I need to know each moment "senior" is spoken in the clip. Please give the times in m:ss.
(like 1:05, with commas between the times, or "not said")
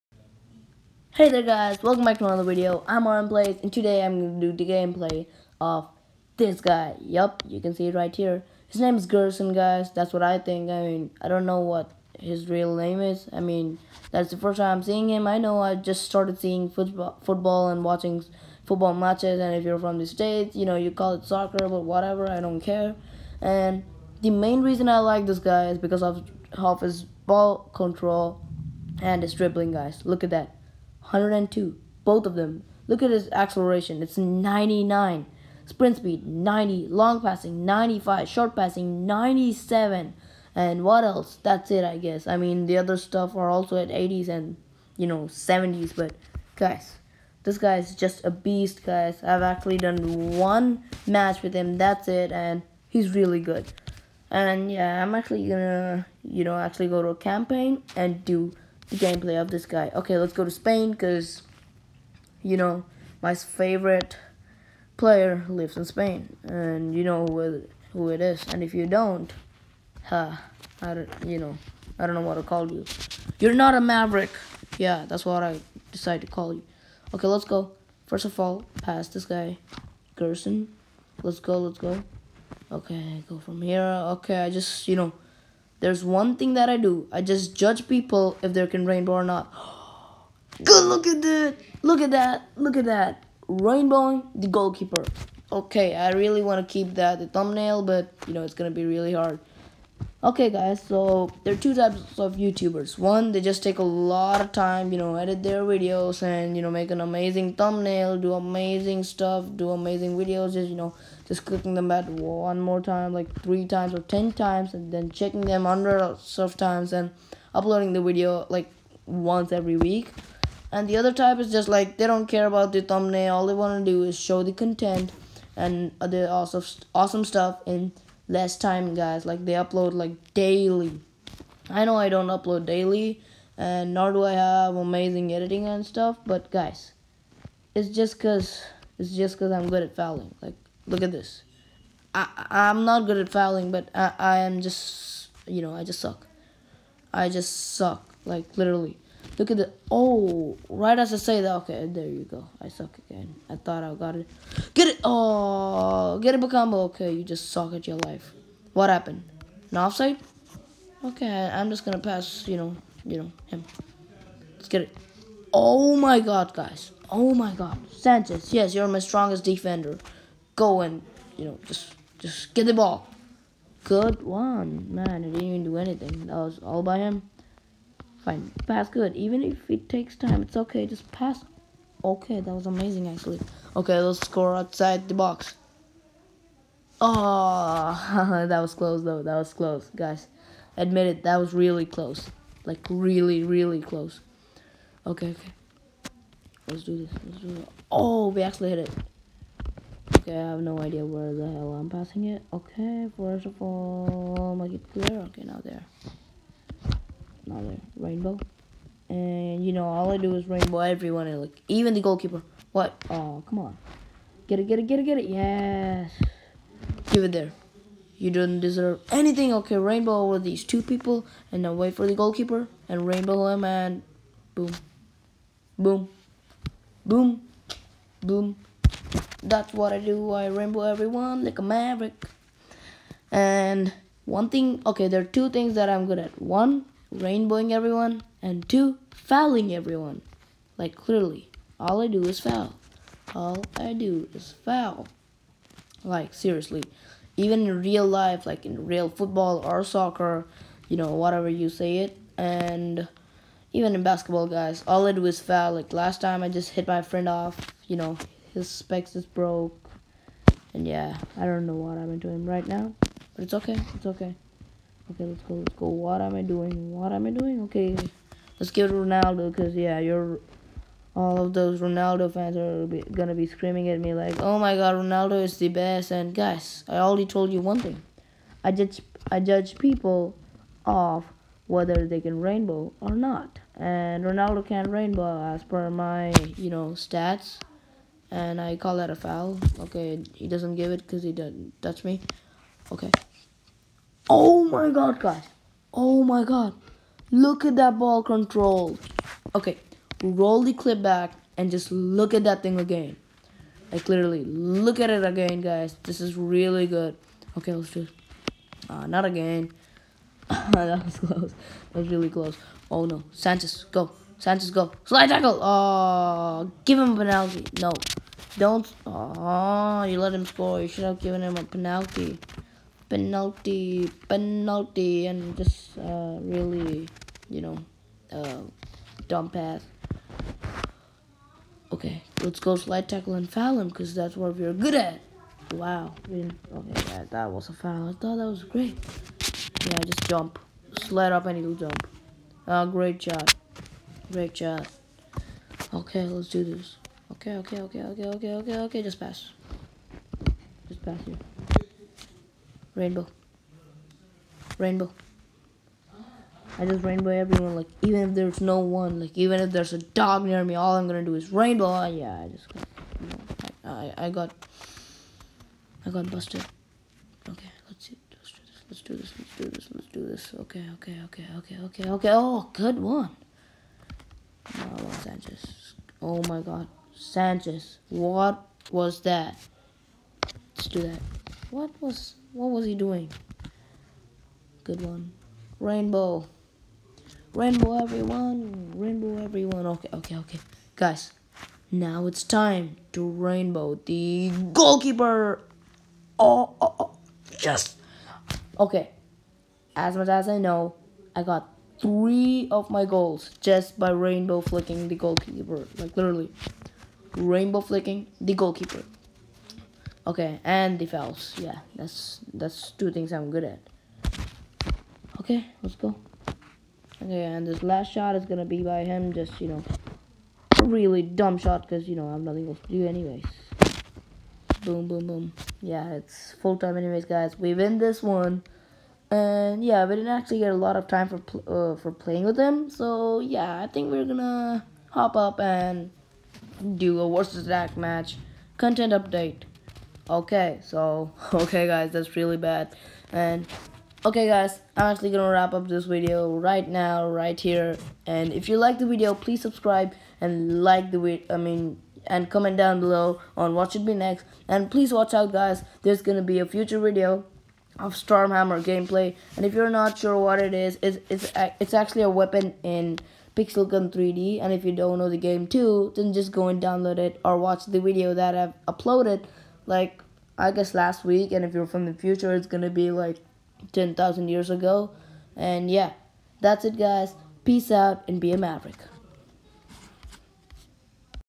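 not said.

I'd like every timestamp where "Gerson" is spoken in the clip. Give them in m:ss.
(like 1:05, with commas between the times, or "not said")
0:09, 1:20.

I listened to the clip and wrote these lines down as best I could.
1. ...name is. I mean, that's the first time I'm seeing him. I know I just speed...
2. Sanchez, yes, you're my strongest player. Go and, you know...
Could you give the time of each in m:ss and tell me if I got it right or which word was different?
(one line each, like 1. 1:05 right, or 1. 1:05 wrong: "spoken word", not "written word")
1. 0:12 wrong: "started", not "speed"
2. 2:47 wrong: "defender", not "player".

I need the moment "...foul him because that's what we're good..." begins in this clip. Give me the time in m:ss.
5:33.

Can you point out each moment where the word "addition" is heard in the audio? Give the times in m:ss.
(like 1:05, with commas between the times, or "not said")
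not said.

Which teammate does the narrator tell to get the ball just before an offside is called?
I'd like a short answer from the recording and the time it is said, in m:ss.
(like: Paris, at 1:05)
Bakambu, at 2:36.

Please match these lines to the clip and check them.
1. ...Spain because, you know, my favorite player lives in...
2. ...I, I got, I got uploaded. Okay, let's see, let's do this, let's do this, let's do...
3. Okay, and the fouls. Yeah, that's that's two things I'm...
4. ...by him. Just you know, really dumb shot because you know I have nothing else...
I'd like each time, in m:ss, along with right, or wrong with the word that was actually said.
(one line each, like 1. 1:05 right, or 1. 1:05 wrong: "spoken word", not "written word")
1. 1:00 right
2. 6:04 wrong: "busted", not "uploaded"
3. 6:50 right
4. 6:58 right.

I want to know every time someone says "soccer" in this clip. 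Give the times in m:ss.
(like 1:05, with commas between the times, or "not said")
0:21, 4:09.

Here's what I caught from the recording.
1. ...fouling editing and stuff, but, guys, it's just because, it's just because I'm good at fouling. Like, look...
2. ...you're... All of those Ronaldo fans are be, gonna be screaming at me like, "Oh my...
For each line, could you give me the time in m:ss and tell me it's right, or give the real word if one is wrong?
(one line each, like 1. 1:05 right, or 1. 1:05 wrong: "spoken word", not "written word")
1. 2:14 wrong: "amazing", not "fouling"
2. 4:29 right.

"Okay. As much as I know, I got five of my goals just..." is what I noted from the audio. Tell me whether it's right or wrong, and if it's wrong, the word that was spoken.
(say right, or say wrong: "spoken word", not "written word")
wrong: "three", not "five".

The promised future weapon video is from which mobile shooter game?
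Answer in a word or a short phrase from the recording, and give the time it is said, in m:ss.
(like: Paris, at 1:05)
Pixel Gun 3D, at 7:43.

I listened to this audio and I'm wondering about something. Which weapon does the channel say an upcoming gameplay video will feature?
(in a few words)
Stormhammer.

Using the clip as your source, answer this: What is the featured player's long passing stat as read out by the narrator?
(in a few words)
95.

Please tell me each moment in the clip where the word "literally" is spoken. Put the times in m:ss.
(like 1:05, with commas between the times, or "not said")
2:28, 5:04, 6:46.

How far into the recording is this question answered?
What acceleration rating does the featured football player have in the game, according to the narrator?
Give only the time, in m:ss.
0:34.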